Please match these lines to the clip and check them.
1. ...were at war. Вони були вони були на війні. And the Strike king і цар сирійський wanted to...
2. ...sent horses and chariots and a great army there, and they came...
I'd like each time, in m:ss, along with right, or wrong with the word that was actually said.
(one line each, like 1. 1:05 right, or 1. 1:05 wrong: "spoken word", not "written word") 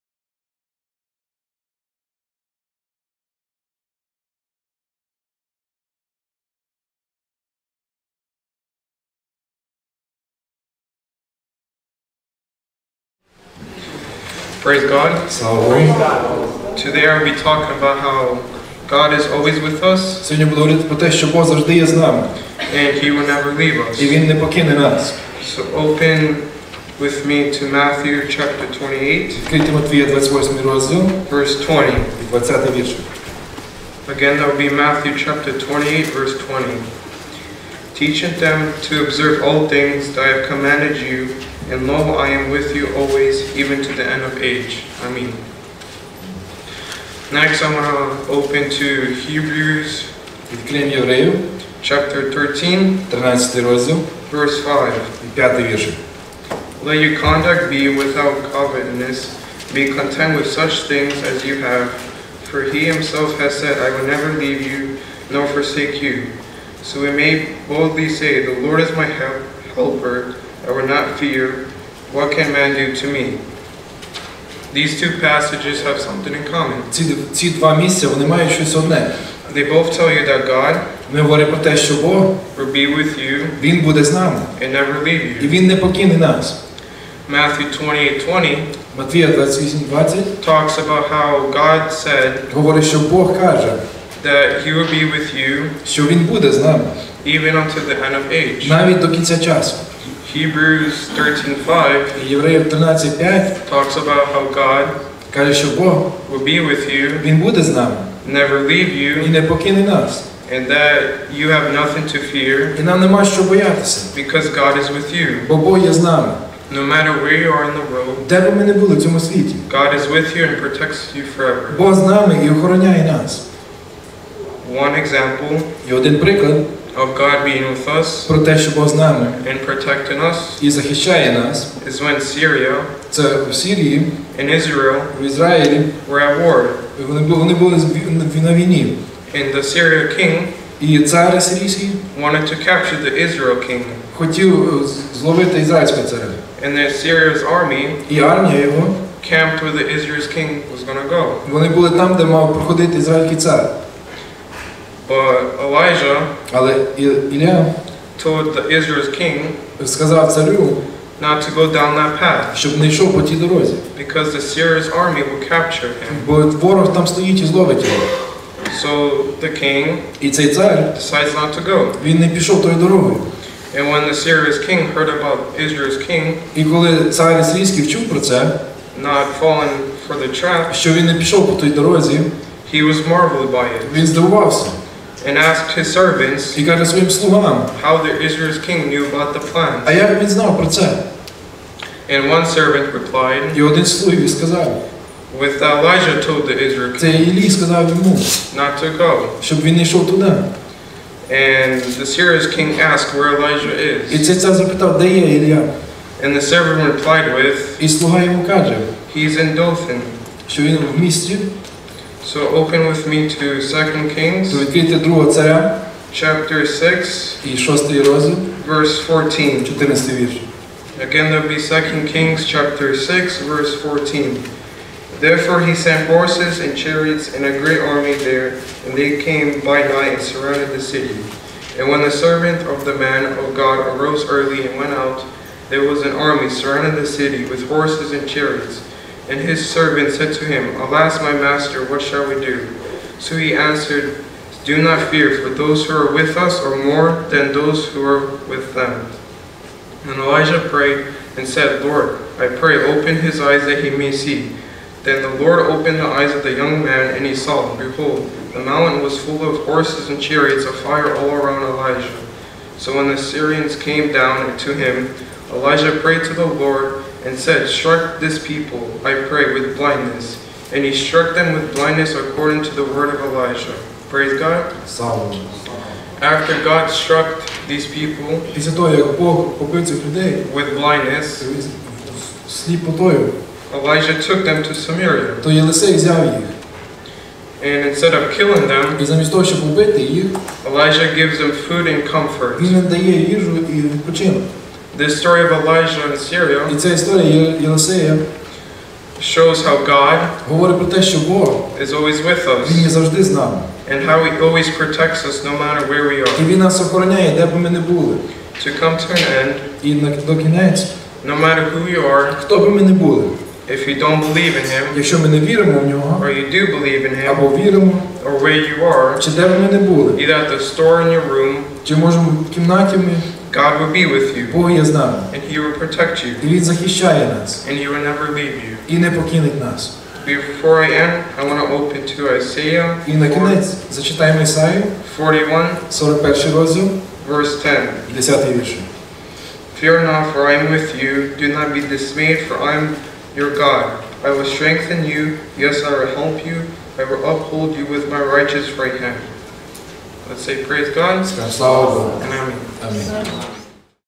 1. 2:16 wrong: "Syrian", not "Strike"
2. 3:45 right.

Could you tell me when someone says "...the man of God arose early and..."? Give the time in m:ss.
3:52.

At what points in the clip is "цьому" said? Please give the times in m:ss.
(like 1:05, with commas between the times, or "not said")
1:59.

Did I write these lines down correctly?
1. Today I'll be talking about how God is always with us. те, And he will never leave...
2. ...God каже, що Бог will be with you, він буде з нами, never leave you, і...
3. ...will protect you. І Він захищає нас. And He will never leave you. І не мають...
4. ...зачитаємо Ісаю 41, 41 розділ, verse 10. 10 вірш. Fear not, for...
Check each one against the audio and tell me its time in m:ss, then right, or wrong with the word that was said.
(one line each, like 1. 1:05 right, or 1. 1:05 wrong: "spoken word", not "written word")
1. 0:16 right
2. 1:44 right
3. 5:25 wrong: "покинуть", not "мають"
4. 5:33 right.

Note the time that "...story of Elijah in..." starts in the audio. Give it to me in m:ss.
4:55.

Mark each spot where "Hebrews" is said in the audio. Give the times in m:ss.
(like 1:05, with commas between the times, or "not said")
0:49, 1:40.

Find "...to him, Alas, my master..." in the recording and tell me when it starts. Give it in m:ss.
4:00.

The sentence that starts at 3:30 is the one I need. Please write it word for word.
Що він в місті so open with me to 2 Kings.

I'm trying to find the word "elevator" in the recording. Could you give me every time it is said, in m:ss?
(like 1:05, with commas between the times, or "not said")
not said.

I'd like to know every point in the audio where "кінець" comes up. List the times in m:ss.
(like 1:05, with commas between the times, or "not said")
5:10, 5:33.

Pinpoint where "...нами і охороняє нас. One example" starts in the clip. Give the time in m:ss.
2:02.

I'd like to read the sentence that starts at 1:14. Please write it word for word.
These two passages have something in common.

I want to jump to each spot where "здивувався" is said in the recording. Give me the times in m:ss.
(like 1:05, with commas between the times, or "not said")
3:04.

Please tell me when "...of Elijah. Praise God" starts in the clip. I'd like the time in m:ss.
4:33.